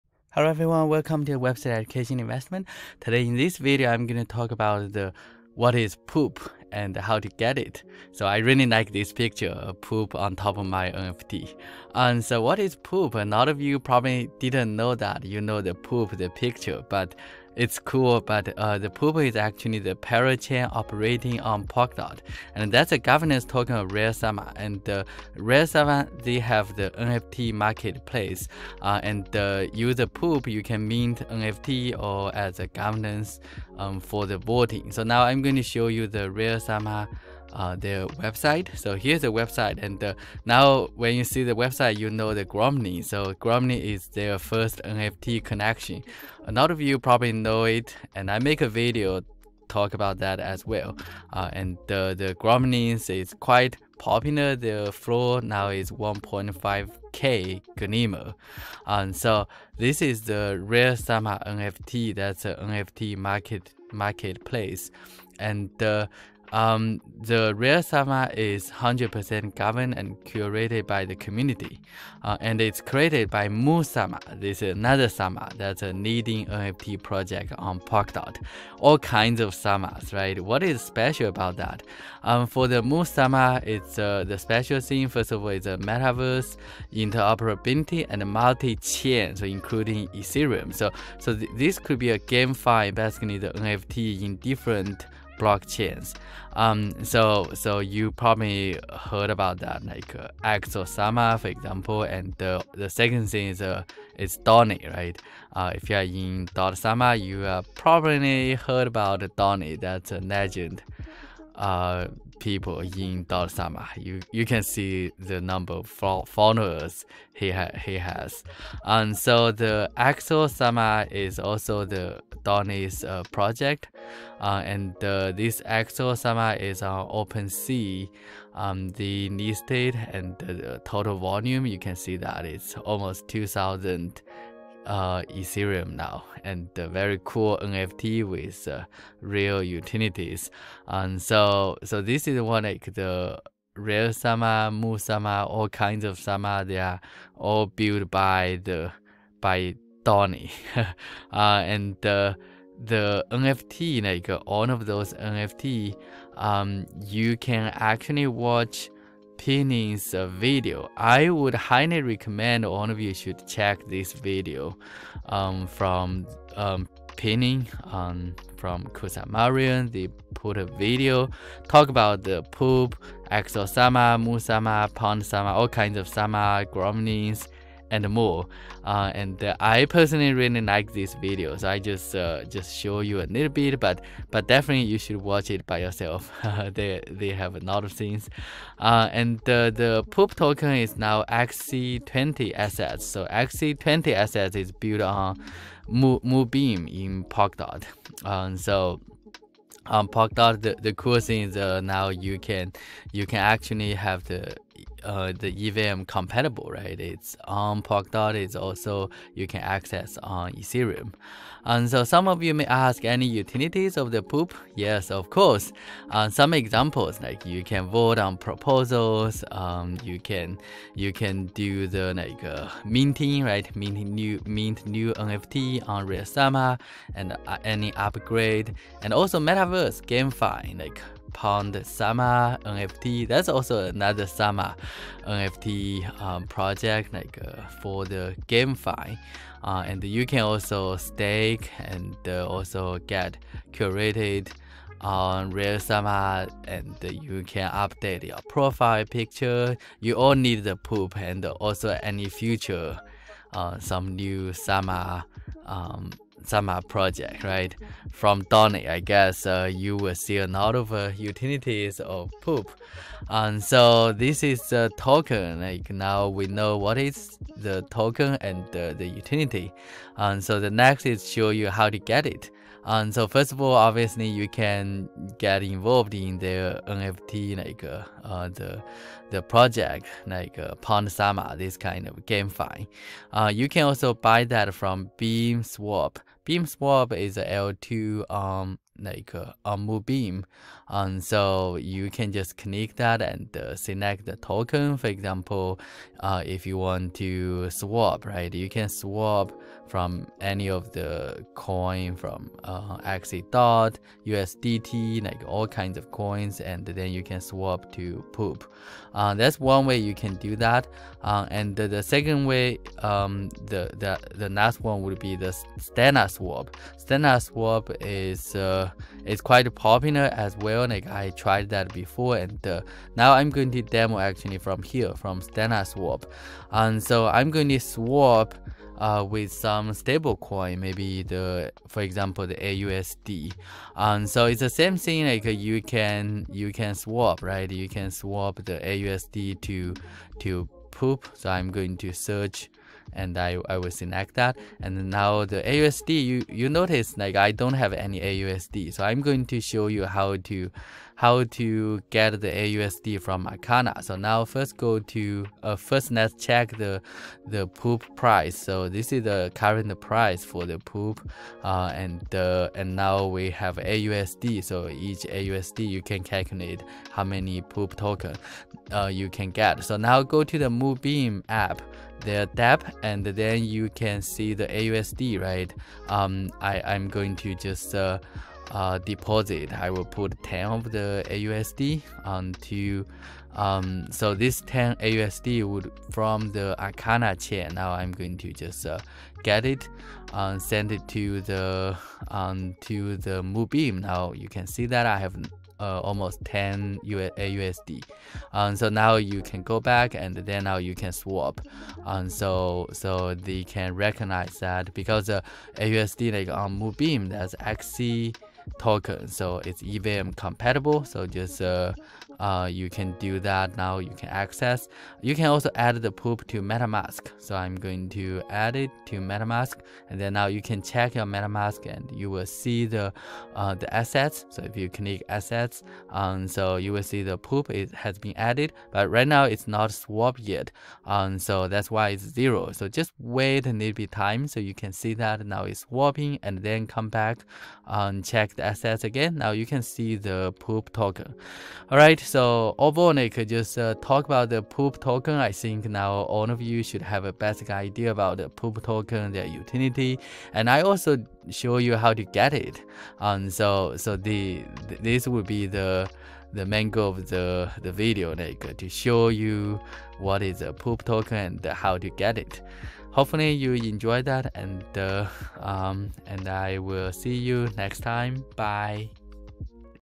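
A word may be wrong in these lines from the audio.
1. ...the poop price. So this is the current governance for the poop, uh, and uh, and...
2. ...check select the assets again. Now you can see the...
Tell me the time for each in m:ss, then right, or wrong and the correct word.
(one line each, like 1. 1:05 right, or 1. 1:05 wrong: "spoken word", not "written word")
1. 5:57 wrong: "price", not "governance"
2. 7:18 right.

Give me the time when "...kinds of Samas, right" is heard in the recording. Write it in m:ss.
1:18.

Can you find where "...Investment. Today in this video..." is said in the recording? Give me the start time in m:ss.
0:02.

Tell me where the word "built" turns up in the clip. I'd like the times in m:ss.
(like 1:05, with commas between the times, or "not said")
2:27, 3:14.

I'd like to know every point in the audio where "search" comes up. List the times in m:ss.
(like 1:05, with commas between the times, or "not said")
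5:42.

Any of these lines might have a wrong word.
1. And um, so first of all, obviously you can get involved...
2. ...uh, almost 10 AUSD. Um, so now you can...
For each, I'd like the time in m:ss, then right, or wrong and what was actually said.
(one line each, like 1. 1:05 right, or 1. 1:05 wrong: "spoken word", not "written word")
1. 4:32 right
2. 6:35 right.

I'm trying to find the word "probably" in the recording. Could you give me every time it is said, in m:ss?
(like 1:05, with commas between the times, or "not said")
0:13, 0:46, 1:38, 1:47.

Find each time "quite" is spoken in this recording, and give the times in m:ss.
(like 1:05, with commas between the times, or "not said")
0:53, 5:19.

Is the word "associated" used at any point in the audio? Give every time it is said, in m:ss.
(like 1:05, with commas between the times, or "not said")
not said.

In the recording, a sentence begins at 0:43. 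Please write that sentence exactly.
So Gromny is their first NFT connection.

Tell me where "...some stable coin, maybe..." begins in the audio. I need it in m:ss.
5:29.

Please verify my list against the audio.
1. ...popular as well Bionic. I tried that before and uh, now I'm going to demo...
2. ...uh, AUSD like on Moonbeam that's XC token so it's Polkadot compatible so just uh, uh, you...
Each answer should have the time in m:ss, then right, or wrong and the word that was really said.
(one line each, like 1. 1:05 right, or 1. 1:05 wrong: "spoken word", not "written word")
1. 5:19 right
2. 6:45 wrong: "EVM", not "Polkadot".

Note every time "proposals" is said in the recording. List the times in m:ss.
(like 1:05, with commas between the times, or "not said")
3:38.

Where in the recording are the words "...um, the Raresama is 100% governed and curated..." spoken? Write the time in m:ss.
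1:06.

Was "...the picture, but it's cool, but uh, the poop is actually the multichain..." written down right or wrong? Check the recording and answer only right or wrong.
wrong.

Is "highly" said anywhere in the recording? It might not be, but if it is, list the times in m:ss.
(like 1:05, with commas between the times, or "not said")
2:41.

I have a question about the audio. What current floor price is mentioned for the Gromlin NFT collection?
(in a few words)
1.5k.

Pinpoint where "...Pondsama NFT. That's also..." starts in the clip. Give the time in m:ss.
3:51.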